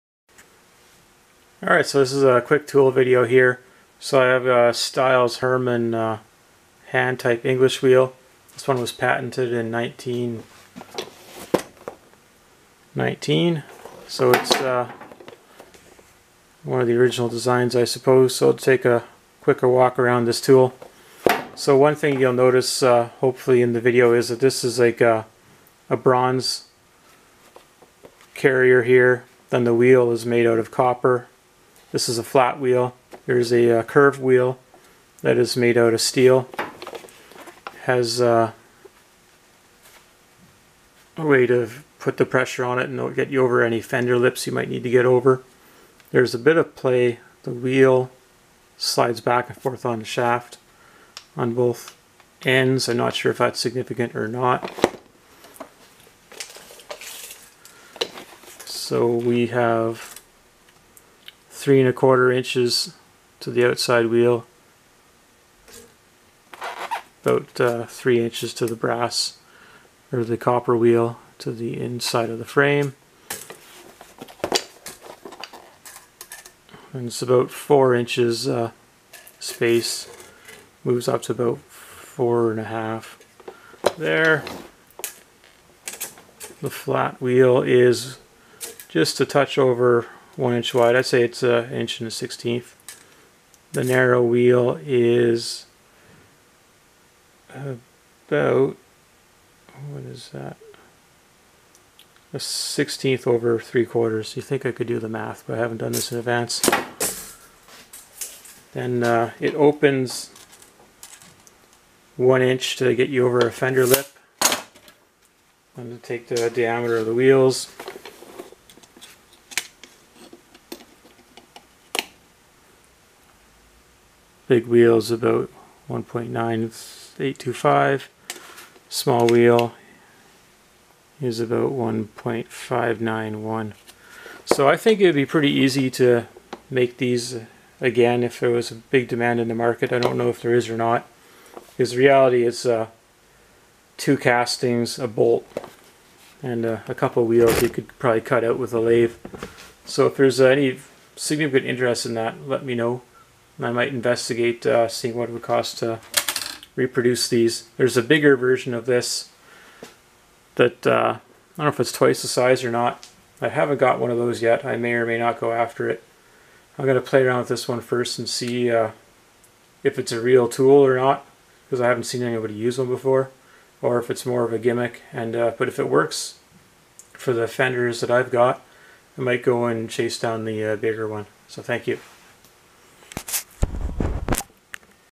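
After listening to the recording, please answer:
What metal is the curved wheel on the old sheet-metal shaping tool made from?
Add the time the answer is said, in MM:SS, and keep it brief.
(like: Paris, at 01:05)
Steel, at 00:35.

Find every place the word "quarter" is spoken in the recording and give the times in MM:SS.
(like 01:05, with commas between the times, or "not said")
01:01, 01:43.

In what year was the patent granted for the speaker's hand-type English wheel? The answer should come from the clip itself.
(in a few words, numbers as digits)
1919.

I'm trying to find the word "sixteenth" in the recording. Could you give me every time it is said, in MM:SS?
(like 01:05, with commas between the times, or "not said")
01:32, 01:42.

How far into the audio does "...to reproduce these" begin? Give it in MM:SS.
02:35.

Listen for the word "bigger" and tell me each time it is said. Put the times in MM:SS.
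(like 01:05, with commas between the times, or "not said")
02:38, 03:00.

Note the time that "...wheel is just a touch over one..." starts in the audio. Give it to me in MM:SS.
01:27.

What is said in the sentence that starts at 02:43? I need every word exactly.
I haven't got one of those yet.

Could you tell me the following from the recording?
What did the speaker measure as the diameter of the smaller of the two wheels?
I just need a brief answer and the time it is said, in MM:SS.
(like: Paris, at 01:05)
1.591, at 02:11.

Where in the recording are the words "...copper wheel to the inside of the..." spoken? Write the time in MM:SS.
01:10.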